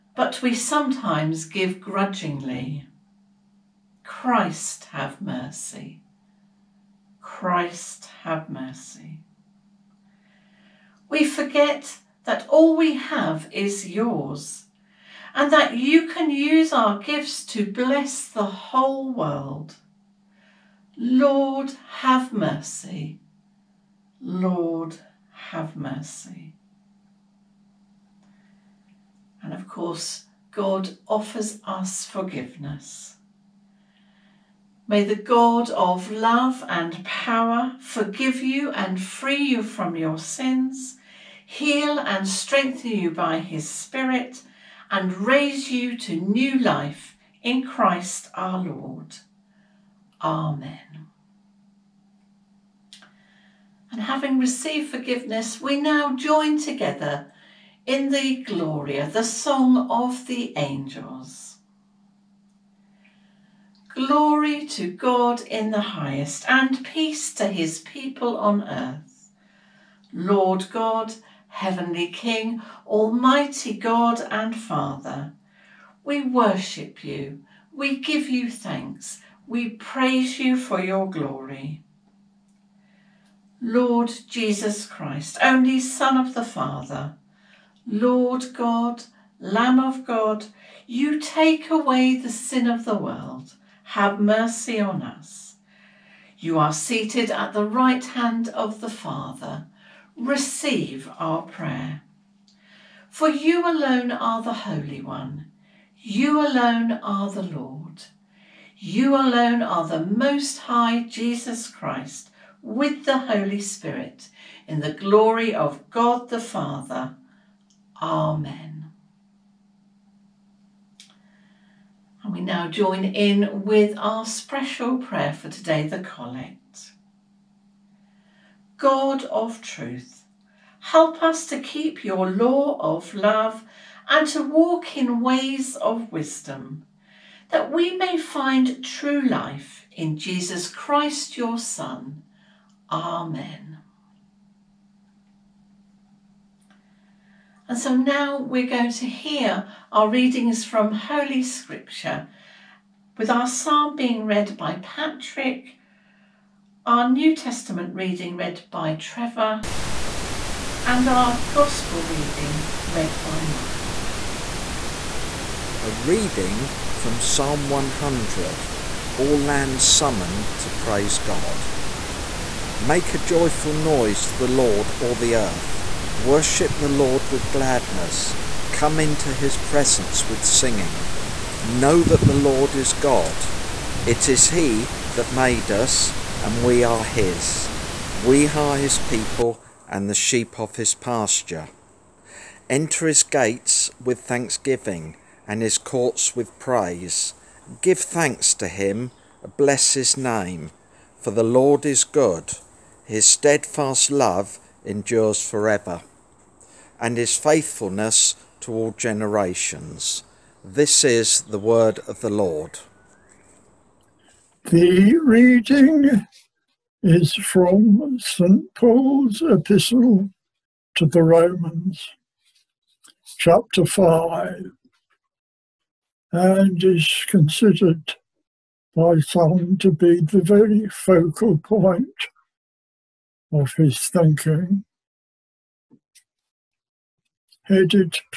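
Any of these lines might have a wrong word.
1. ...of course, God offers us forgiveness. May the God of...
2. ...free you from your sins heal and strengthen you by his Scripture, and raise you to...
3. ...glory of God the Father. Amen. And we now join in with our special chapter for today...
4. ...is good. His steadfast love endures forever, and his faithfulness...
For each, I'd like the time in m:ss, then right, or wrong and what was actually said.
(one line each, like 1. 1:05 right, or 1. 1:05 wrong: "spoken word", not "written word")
1. 0:29 right
2. 0:39 wrong: "Spirit", not "Scripture"
3. 1:54 wrong: "prayer", not "chapter"
4. 3:21 right.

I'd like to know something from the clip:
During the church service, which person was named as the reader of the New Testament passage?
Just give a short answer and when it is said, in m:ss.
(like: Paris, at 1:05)
Trevor, at 2:38.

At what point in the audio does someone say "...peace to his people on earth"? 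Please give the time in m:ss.
1:06.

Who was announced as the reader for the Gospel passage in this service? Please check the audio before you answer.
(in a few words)
Mike.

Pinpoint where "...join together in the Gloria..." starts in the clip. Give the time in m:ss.
0:56.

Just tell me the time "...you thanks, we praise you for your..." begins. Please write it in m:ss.
1:18.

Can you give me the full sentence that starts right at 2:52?
Make a joyful noise to the Lord, all the earth.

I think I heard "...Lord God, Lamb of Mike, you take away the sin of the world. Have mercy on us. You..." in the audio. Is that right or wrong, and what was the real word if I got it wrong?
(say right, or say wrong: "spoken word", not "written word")
wrong: "God", not "Mike".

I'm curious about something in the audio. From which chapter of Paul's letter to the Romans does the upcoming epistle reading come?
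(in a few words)
5.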